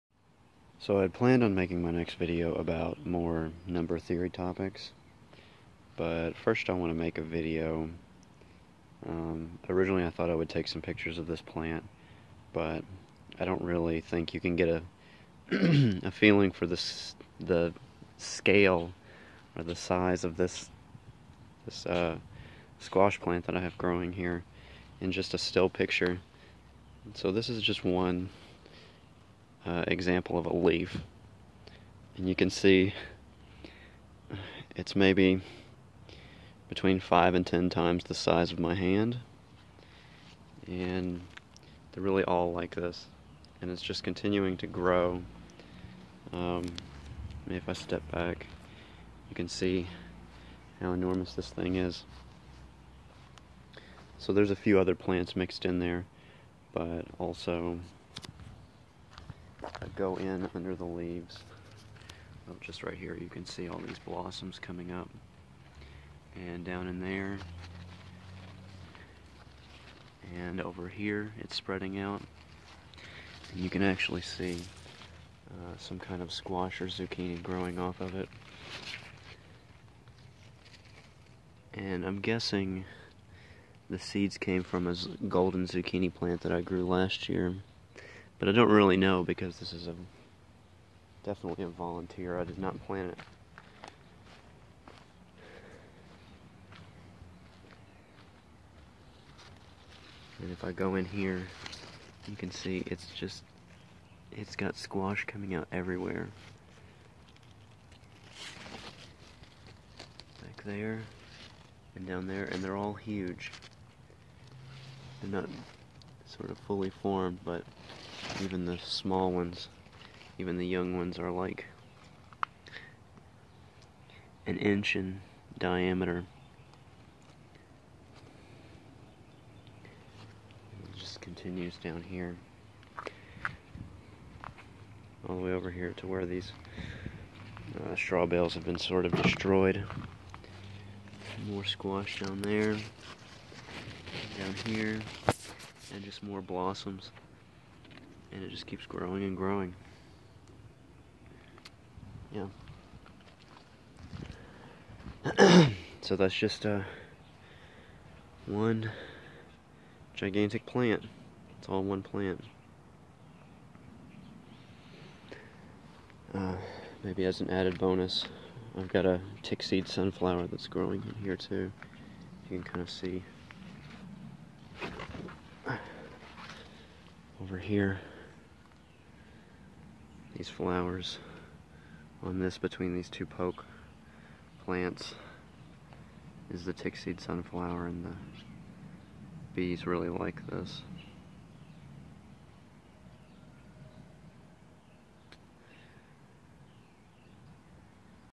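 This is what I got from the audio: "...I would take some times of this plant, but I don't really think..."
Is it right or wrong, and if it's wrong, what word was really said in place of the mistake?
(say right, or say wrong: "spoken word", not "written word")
wrong: "pictures", not "times".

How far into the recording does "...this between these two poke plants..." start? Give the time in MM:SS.
03:02.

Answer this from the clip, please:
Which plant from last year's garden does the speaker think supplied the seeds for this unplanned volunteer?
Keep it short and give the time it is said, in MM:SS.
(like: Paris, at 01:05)
golden zucchini, at 01:25.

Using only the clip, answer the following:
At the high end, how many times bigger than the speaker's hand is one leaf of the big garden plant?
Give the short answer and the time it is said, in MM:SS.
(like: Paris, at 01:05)
10, at 00:37.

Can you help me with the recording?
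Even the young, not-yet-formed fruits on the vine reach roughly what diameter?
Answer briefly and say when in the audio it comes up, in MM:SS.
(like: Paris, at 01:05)
an inch, at 02:04.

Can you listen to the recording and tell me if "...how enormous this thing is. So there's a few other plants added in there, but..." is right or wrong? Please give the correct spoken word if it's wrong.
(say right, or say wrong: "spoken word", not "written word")
wrong: "mixed", not "added".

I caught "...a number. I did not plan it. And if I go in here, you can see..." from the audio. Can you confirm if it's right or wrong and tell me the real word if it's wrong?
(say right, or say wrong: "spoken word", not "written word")
wrong: "volunteer", not "number".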